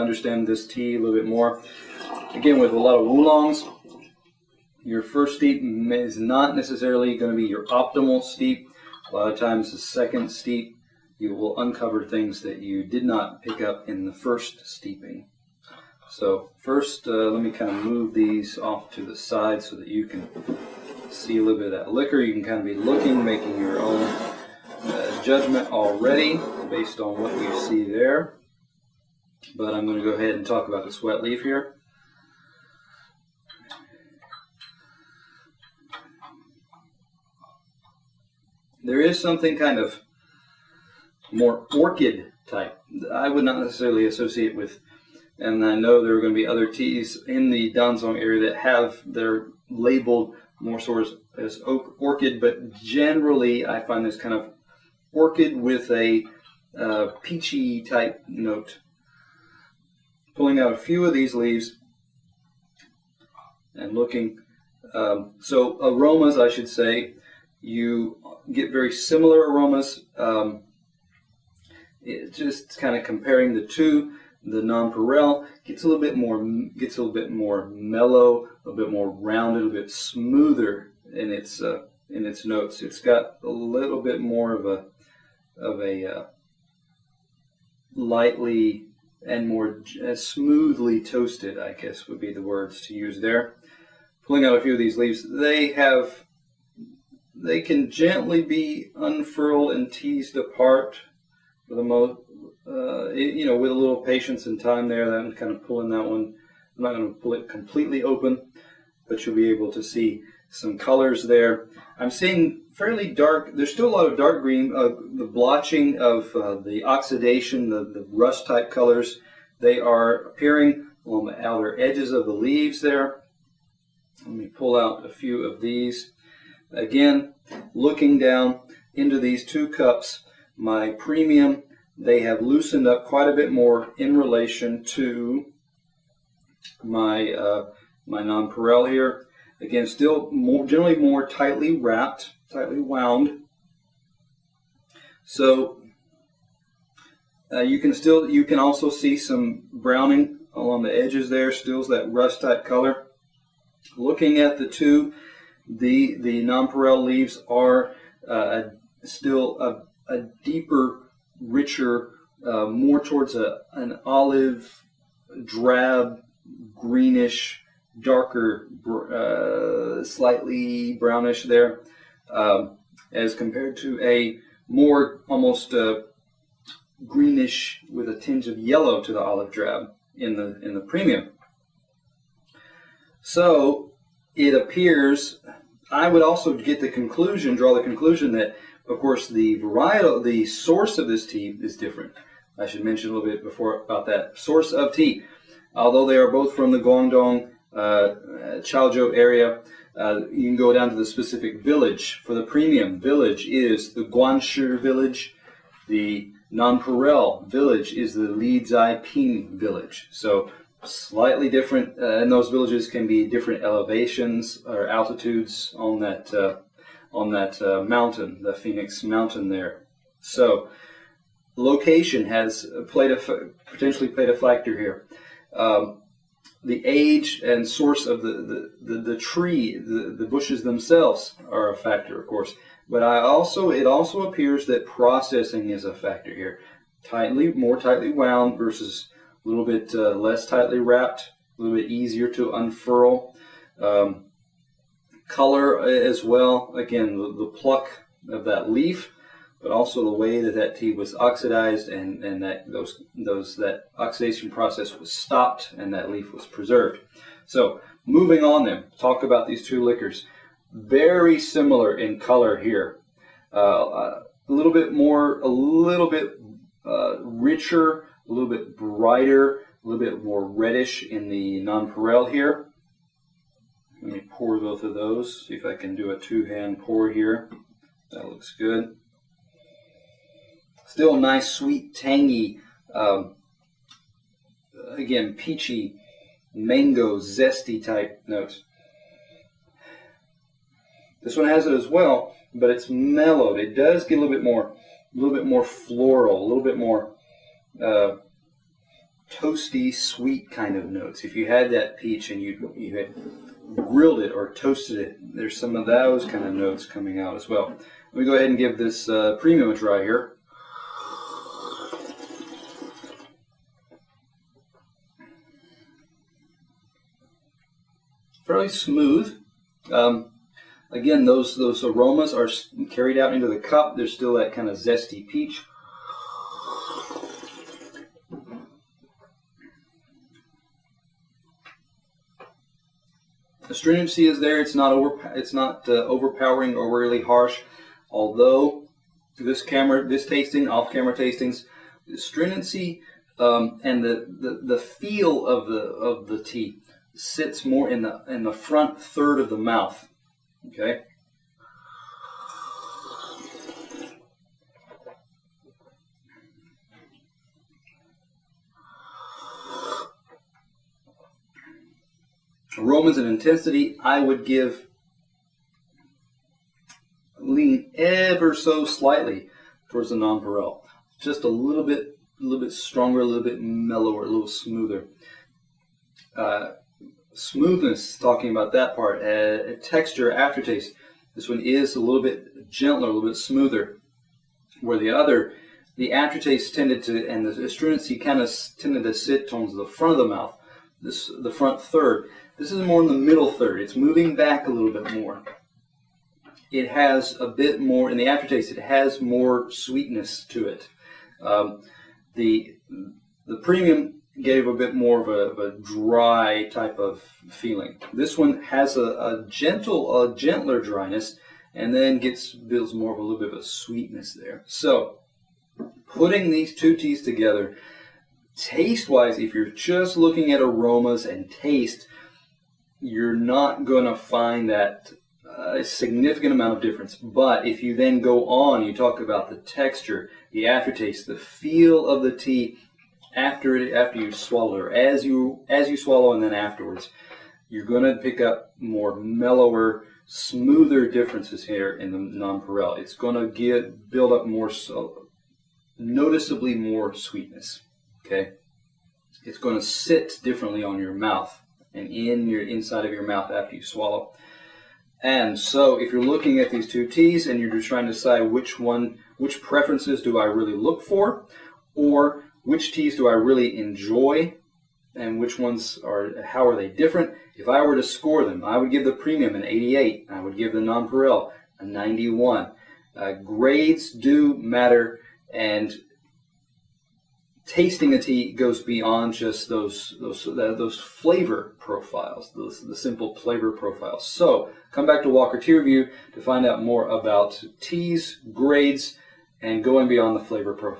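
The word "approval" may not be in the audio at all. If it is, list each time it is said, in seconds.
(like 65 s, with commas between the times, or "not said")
not said.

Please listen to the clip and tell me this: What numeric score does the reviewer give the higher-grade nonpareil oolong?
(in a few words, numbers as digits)
91.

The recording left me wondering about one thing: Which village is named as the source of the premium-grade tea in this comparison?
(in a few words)
Guanshi village.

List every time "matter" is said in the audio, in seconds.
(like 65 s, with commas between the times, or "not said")
474 s.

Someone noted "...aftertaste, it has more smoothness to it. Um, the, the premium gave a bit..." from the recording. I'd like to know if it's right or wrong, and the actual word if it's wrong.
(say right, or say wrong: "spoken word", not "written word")
wrong: "sweetness", not "smoothness".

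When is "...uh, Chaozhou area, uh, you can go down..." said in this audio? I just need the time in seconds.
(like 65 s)
197 s.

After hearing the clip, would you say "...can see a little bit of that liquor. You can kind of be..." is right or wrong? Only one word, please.
right.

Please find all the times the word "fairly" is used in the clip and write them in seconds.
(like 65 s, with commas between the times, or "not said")
112 s, 318 s.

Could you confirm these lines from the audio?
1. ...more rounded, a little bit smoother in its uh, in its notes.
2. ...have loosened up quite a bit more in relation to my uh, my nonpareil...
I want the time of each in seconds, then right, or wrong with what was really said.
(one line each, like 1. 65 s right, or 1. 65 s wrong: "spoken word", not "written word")
1. 78 s right
2. 132 s right.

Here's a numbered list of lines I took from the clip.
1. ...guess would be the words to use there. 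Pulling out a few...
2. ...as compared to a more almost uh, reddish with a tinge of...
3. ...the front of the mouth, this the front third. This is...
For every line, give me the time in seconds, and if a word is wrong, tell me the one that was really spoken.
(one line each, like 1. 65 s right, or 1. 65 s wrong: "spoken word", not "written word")
1. 91 s right
2. 173 s wrong: "greenish", not "reddish"
3. 389 s right.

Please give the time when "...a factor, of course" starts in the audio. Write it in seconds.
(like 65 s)
231 s.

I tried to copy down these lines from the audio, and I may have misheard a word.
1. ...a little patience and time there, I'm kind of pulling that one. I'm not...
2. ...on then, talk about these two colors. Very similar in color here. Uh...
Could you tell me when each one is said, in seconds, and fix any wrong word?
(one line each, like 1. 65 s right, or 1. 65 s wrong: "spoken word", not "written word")
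1. 103 s right
2. 258 s wrong: "liquors", not "colors".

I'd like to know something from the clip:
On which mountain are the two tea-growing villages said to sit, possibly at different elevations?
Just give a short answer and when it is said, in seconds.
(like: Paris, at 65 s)
Phoenix Mountain, at 218 s.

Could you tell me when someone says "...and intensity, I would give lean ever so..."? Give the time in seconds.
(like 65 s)
363 s.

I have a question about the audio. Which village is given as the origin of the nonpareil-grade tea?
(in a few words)
Lizai Ping village.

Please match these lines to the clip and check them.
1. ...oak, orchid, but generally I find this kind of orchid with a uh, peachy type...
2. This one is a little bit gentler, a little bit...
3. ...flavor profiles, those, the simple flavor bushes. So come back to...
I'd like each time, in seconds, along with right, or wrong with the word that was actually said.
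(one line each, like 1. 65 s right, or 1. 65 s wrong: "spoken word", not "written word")
1. 51 s right
2. 381 s right
3. 480 s wrong: "profiles", not "bushes".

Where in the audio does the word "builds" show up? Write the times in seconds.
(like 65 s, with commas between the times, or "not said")
412 s, 444 s.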